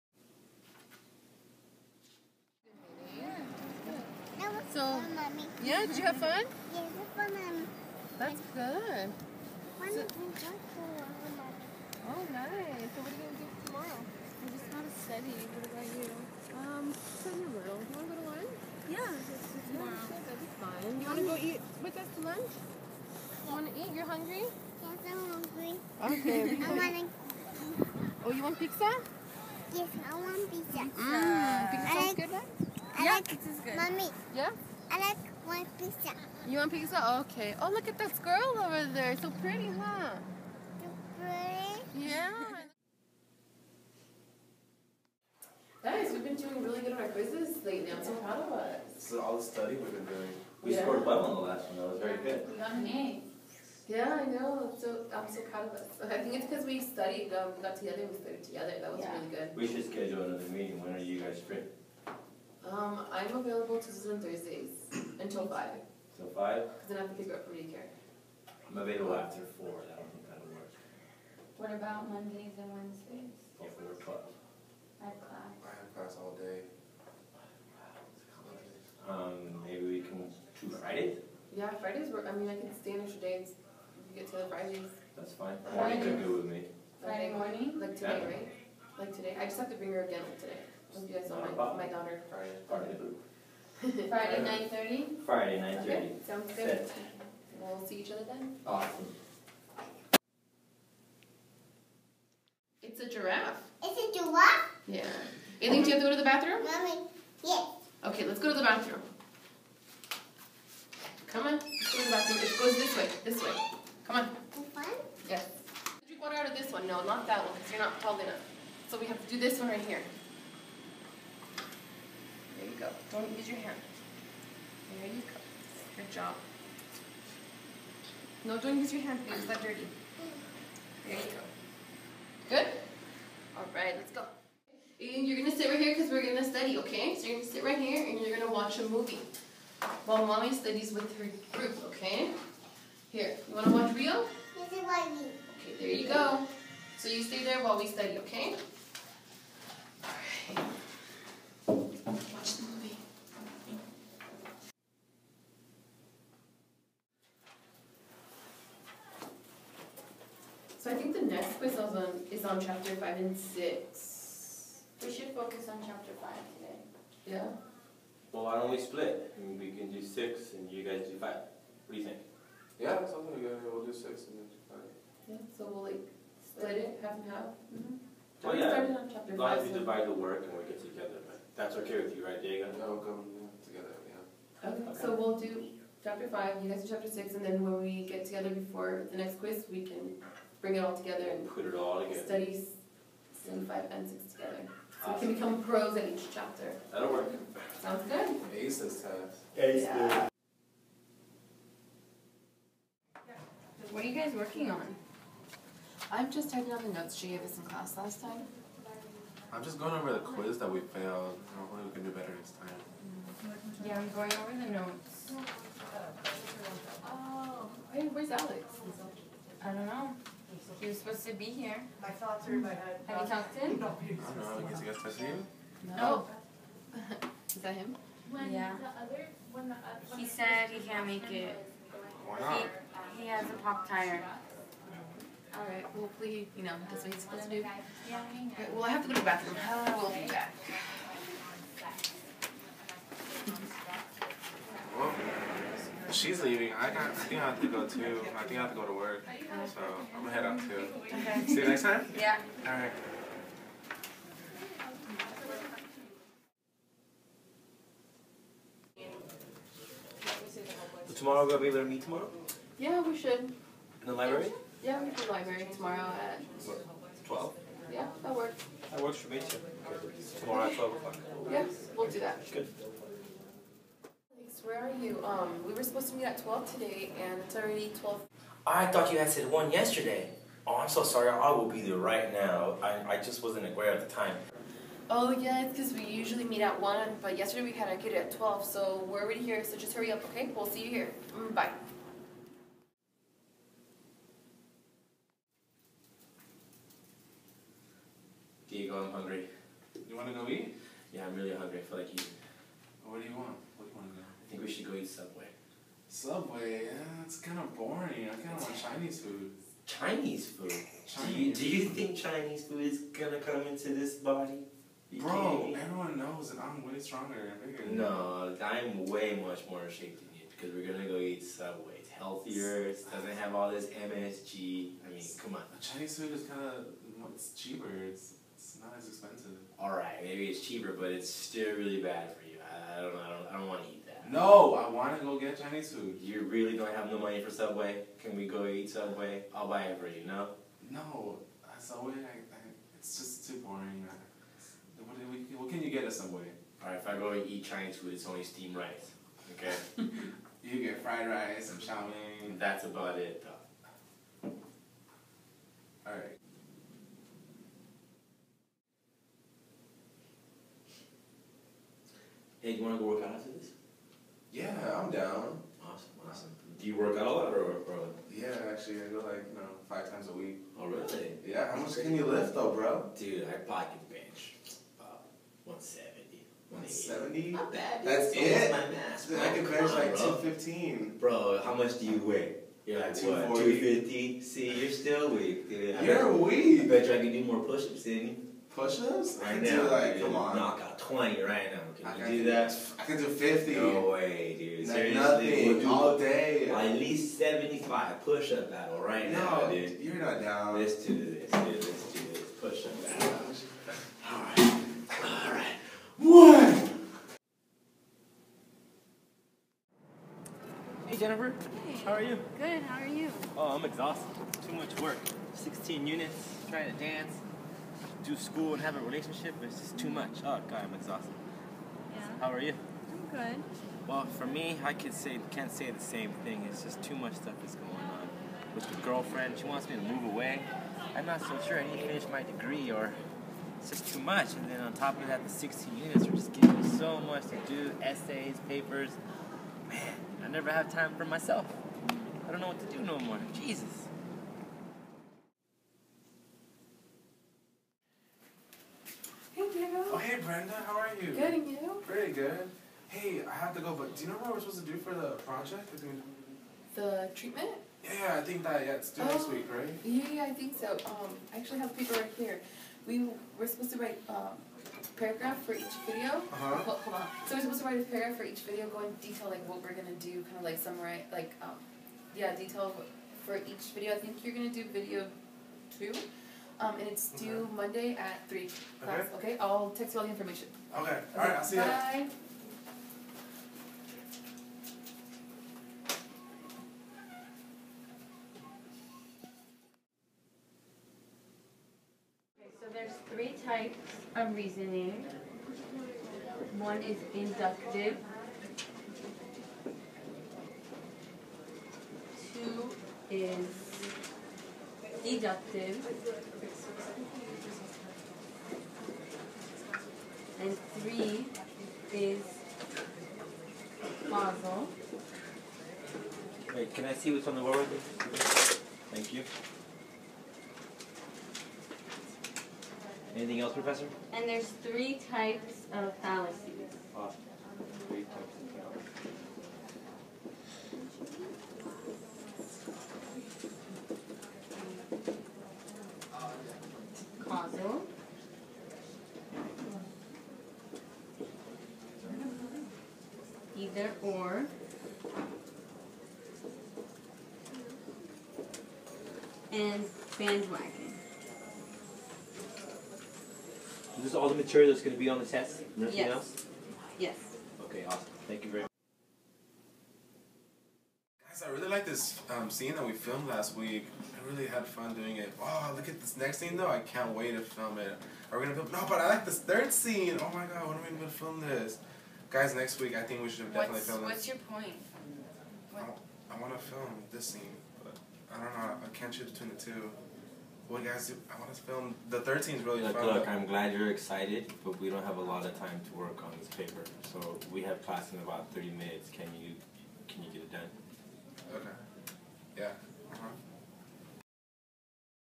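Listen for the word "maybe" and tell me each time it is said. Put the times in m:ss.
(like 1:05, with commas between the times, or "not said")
1:19, 5:30.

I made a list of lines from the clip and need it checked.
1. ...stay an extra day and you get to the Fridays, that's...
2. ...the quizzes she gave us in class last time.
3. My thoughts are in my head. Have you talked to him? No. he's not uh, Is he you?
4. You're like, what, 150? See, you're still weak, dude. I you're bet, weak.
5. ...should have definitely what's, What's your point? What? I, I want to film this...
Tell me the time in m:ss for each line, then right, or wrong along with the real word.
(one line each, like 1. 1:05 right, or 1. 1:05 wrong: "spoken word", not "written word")
1. 1:22 right
2. 3:26 wrong: "notes", not "quizzes"
3. 3:42 right
4. 6:22 wrong: "250", not "150"
5. 9:33 right.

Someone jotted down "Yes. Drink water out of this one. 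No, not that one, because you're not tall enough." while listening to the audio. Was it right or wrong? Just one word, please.
right.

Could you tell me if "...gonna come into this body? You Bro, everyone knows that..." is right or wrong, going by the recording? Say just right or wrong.
right.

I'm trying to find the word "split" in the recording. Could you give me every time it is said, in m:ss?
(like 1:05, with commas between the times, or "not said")
2:48, 2:56.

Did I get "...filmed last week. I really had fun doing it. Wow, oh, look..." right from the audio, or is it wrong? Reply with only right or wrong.
right.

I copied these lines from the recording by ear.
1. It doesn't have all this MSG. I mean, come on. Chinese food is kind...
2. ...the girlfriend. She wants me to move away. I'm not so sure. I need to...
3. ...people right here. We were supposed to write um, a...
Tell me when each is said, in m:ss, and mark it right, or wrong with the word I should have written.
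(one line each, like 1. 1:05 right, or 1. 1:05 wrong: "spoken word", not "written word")
1. 5:22 right
2. 7:08 right
3. 7:41 right.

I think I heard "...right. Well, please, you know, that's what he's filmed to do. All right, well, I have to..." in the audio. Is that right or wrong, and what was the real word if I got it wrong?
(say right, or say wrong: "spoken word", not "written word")
wrong: "supposed", not "filmed".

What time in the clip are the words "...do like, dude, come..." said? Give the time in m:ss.
6:29.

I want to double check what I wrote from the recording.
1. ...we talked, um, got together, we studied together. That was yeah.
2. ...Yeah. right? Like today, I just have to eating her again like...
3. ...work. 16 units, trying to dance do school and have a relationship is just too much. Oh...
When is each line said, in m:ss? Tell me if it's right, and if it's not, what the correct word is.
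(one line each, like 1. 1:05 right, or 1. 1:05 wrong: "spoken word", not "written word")
1. 0:56 wrong: "studied", not "talked"
2. 1:28 wrong: "bring", not "eating"
3. 6:55 right.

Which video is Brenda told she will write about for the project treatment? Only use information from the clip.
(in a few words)
Video 2.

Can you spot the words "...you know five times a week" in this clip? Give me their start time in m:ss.
6:09.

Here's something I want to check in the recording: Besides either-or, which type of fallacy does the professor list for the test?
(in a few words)
Bandwagon.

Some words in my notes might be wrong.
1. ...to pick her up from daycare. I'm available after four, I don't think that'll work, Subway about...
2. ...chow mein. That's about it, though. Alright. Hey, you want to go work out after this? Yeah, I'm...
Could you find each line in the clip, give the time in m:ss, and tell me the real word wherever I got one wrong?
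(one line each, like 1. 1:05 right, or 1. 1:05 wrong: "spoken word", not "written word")
1. 1:07 wrong: "What", not "Subway"
2. 5:51 right.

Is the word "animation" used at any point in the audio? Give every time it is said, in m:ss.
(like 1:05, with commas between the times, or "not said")
not said.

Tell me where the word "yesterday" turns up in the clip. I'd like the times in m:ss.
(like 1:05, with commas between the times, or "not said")
4:39, 4:47.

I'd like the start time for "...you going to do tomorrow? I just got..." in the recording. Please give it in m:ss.
0:13.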